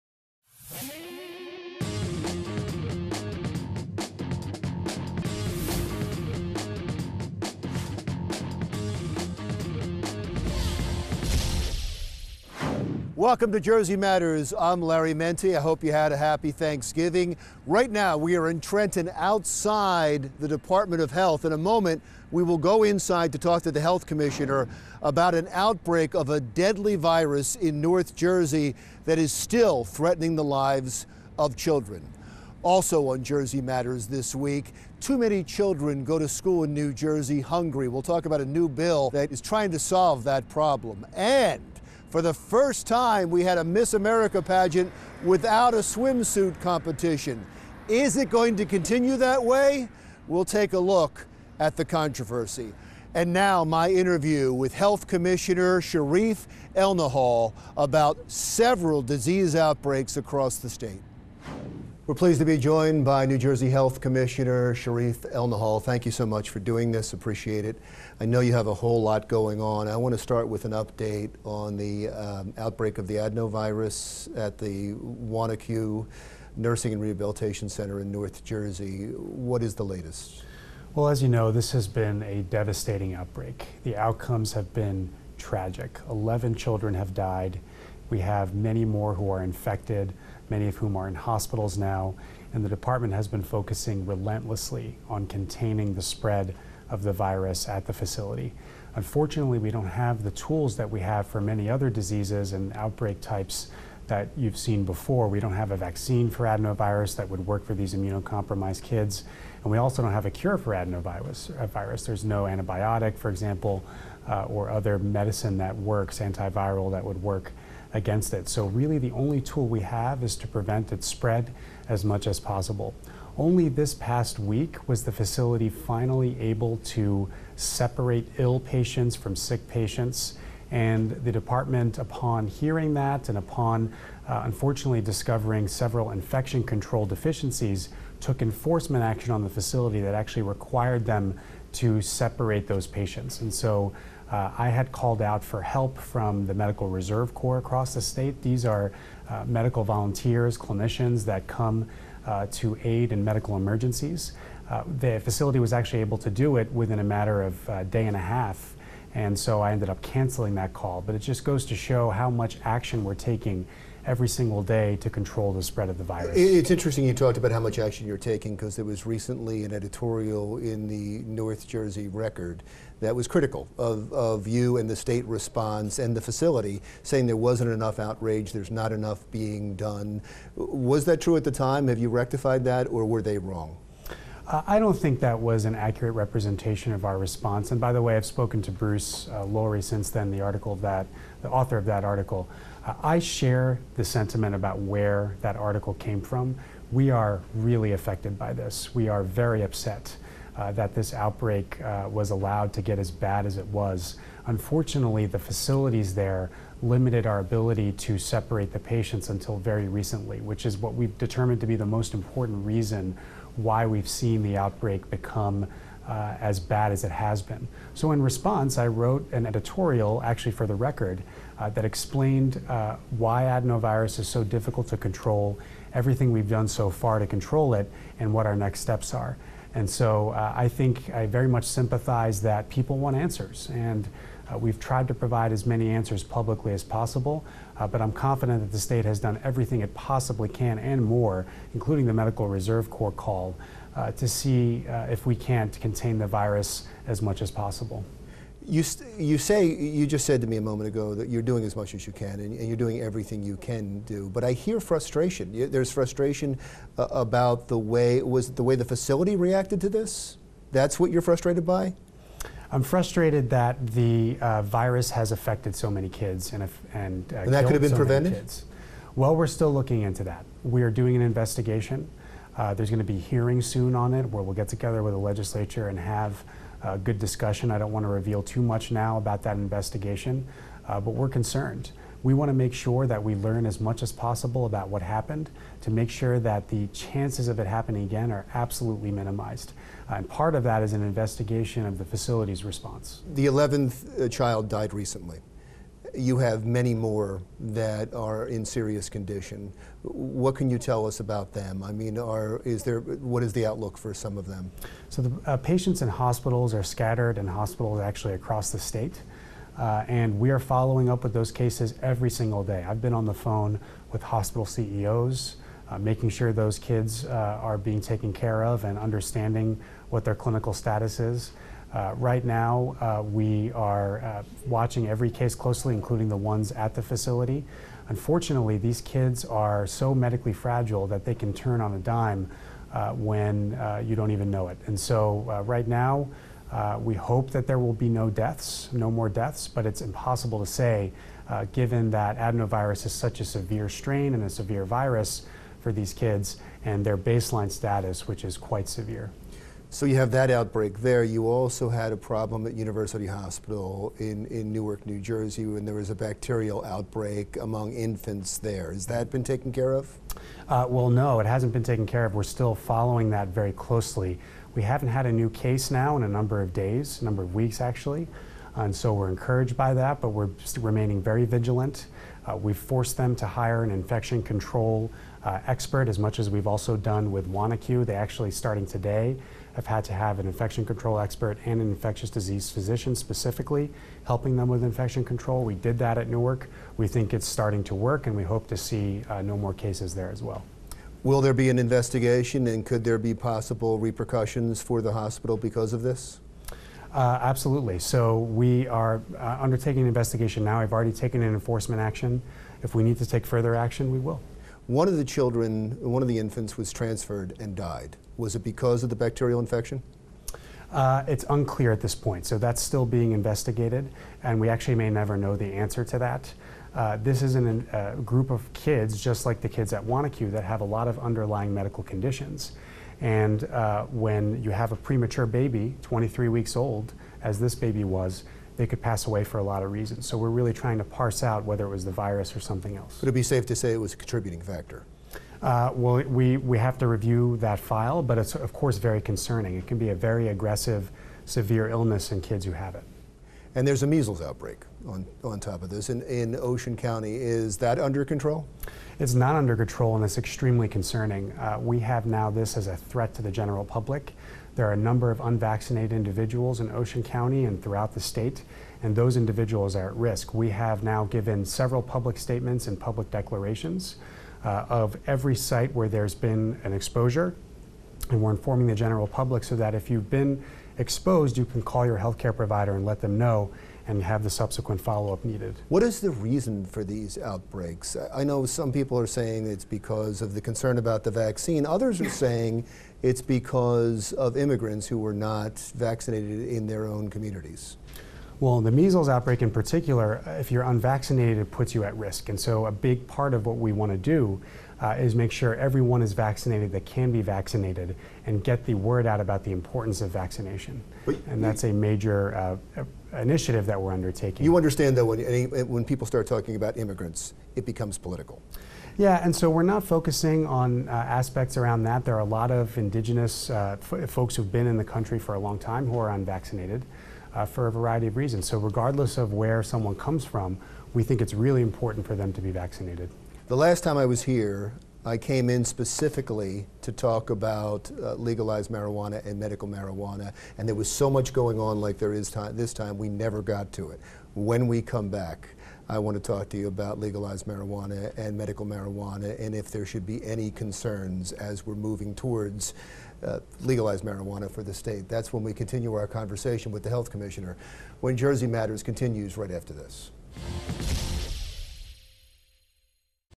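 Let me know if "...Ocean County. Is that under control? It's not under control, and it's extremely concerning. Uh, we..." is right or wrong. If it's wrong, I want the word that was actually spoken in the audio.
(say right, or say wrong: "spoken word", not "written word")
right.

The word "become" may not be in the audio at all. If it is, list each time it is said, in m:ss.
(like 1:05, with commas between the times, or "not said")
3:35, 8:27.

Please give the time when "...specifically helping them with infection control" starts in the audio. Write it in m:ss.
6:23.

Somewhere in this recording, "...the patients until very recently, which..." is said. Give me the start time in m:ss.
3:28.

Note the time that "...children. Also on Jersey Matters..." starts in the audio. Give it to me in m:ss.
0:31.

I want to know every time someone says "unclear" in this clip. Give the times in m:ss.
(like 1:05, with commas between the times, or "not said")
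6:51.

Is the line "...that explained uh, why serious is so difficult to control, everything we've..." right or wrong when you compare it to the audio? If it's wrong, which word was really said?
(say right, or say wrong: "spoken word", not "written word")
wrong: "adenovirus", not "serious".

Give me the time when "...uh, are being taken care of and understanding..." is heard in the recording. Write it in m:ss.
5:17.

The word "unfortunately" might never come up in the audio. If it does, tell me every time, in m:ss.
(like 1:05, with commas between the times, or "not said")
1:38, 2:14, 3:24, 5:28.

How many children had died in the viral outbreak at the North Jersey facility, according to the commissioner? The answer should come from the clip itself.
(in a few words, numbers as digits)
11.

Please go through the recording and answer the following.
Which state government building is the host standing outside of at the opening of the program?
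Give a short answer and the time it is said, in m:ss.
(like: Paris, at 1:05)
Department of Health, at 0:20.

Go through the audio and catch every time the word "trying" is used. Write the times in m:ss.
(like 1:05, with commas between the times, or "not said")
0:39, 7:10.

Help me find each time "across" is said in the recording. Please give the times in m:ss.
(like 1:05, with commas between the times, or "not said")
1:00, 2:27, 5:08.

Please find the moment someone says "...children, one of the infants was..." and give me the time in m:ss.
6:45.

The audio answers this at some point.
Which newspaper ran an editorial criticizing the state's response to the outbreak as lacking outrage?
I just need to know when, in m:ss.
2:51.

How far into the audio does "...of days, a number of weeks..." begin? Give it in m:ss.
6:06.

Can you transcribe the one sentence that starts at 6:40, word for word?
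I've already taken an enforcement action.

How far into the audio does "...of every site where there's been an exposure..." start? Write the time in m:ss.
7:44.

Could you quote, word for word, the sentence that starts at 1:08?
I know you have a whole lot going on.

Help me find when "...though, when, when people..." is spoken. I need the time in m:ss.
8:25.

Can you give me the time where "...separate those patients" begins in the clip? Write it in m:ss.
2:22.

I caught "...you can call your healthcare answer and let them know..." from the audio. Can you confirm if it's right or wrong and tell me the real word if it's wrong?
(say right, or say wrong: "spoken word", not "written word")
wrong: "provider", not "answer".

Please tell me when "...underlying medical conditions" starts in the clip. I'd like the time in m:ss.
7:01.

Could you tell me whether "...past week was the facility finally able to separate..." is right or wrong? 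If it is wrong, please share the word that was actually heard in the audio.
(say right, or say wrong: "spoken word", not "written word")
right.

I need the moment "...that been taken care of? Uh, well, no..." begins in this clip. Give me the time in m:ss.
5:59.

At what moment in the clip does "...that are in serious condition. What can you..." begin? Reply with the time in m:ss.
4:57.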